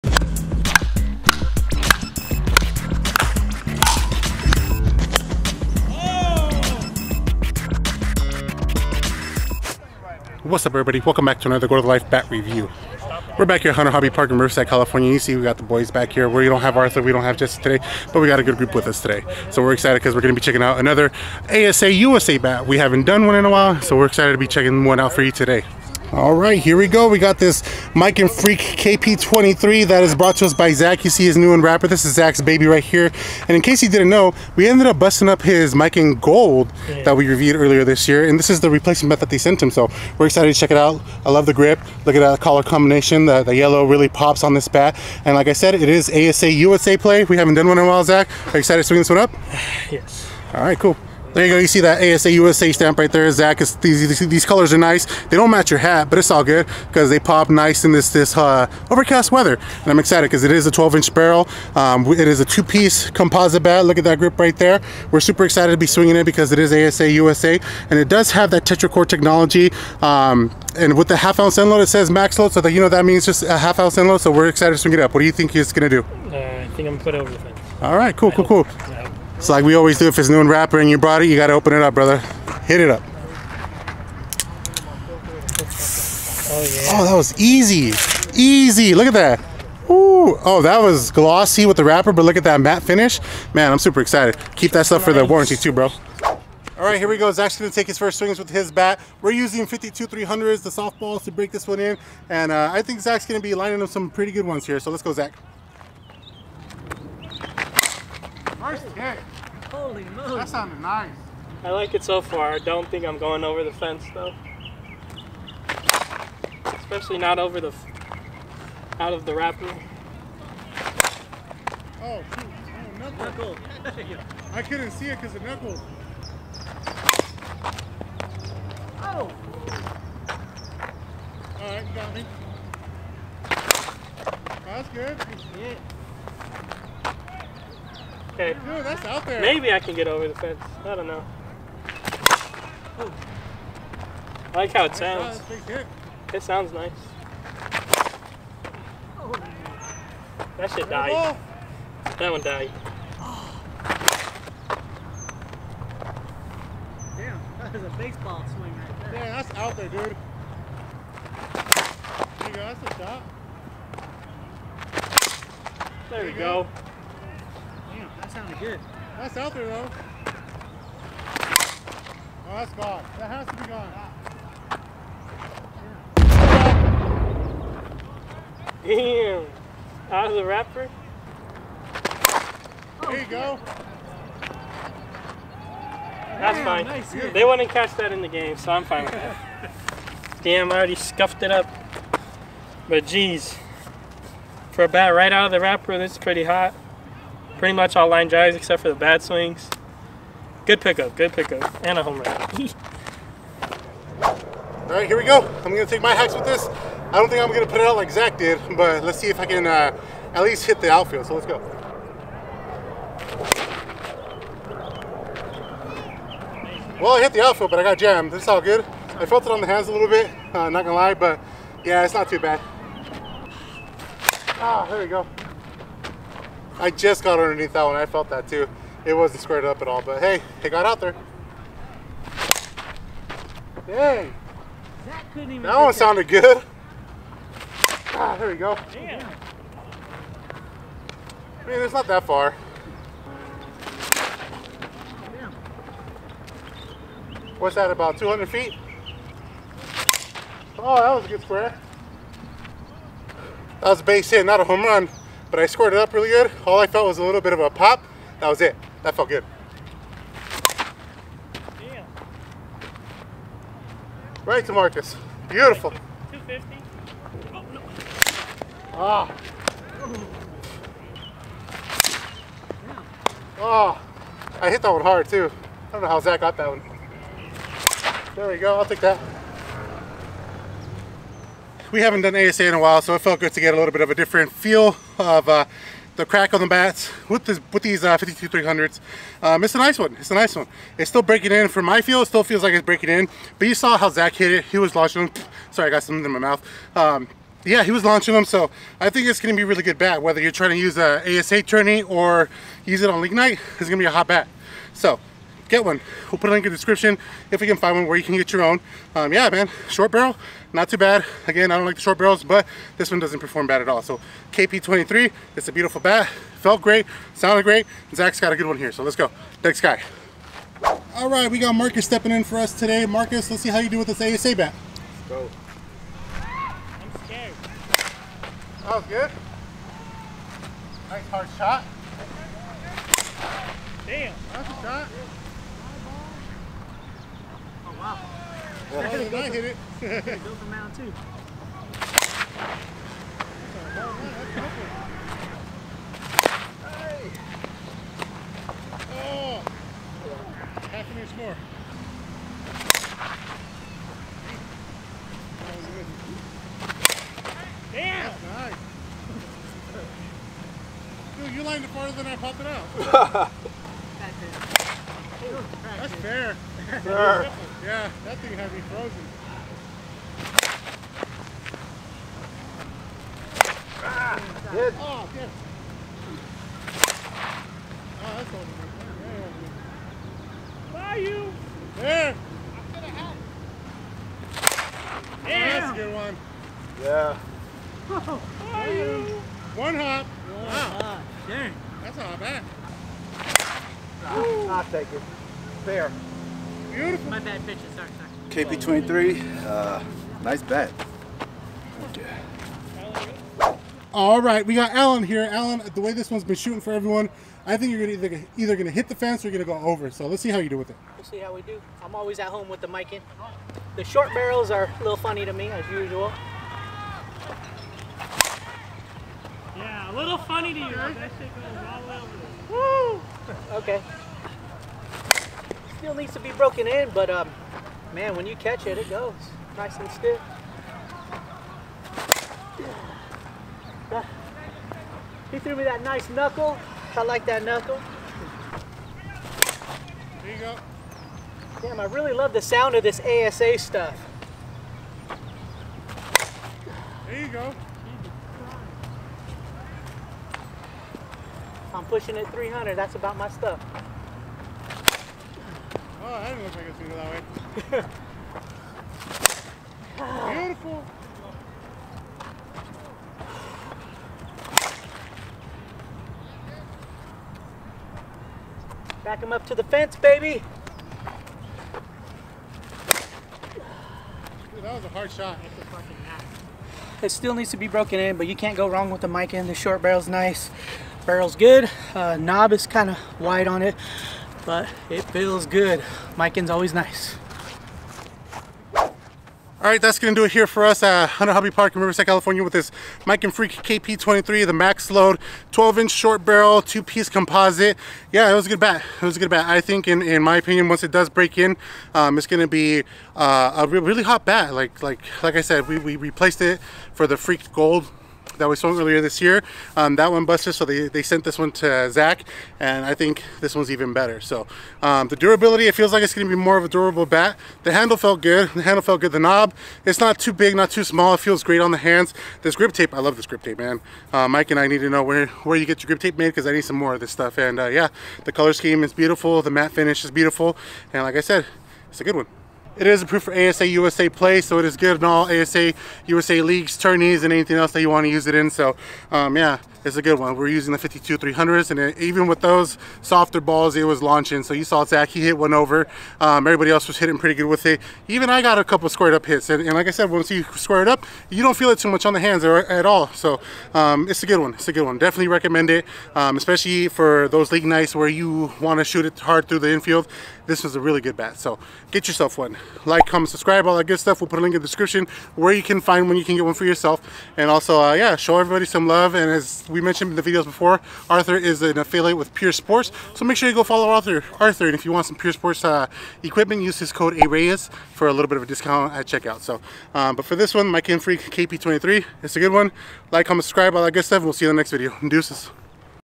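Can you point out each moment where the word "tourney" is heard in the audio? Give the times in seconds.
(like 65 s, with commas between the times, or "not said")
301 s, 536 s.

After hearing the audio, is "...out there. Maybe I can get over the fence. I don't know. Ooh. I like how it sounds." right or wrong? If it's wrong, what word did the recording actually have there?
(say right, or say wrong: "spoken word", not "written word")
right.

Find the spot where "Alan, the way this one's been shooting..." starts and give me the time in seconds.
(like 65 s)
405 s.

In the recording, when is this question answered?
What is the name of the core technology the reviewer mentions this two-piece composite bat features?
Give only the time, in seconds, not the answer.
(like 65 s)
68 s.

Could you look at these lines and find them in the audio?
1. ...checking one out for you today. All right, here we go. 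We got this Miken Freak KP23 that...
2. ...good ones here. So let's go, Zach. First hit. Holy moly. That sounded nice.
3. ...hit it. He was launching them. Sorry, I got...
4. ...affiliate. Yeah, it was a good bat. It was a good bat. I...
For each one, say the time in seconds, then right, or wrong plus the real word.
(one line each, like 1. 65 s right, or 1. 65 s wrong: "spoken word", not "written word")
1. 24 s right
2. 104 s right
3. 294 s right
4. 497 s wrong: "composite", not "affiliate".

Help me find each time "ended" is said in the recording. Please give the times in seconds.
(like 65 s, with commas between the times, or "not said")
34 s.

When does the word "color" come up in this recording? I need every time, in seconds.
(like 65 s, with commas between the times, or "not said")
42 s, 54 s, 528 s.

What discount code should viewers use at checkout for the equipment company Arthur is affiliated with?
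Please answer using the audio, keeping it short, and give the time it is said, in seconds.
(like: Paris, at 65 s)
ARAYES, at 577 s.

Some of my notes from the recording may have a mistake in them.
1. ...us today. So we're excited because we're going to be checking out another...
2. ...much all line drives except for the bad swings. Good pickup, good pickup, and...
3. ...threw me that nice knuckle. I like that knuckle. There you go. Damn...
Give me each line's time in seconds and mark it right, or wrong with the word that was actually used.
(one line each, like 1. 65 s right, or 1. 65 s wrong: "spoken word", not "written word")
1. 18 s right
2. 197 s right
3. 435 s right.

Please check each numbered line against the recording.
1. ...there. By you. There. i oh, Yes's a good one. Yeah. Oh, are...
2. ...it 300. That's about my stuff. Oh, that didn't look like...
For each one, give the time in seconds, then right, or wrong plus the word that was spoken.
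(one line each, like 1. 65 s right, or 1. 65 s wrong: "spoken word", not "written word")
1. 380 s wrong: "That", not "Yes"
2. 452 s right.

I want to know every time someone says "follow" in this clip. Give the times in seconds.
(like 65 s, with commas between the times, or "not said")
573 s.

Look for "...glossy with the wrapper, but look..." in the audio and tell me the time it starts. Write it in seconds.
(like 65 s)
91 s.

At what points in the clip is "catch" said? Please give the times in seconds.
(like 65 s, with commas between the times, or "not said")
187 s, 428 s.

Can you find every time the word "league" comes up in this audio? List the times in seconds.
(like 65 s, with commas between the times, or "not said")
303 s, 536 s, 557 s.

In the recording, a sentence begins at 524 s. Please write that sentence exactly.
Uh, Miken I need to know where, where you get your grip tape made because I need some more of this stuff.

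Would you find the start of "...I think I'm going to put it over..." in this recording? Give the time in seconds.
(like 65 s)
76 s.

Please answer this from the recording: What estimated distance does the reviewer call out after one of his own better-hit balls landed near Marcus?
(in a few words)
250.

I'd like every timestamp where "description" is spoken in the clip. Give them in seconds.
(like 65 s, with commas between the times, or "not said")
306 s, 564 s.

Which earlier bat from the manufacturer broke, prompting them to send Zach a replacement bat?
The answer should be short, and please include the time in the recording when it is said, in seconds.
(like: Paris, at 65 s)
Miken Gold, at 35 s.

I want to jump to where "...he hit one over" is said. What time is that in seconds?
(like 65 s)
545 s.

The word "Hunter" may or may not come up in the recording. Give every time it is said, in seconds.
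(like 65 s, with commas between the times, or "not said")
13 s, 491 s.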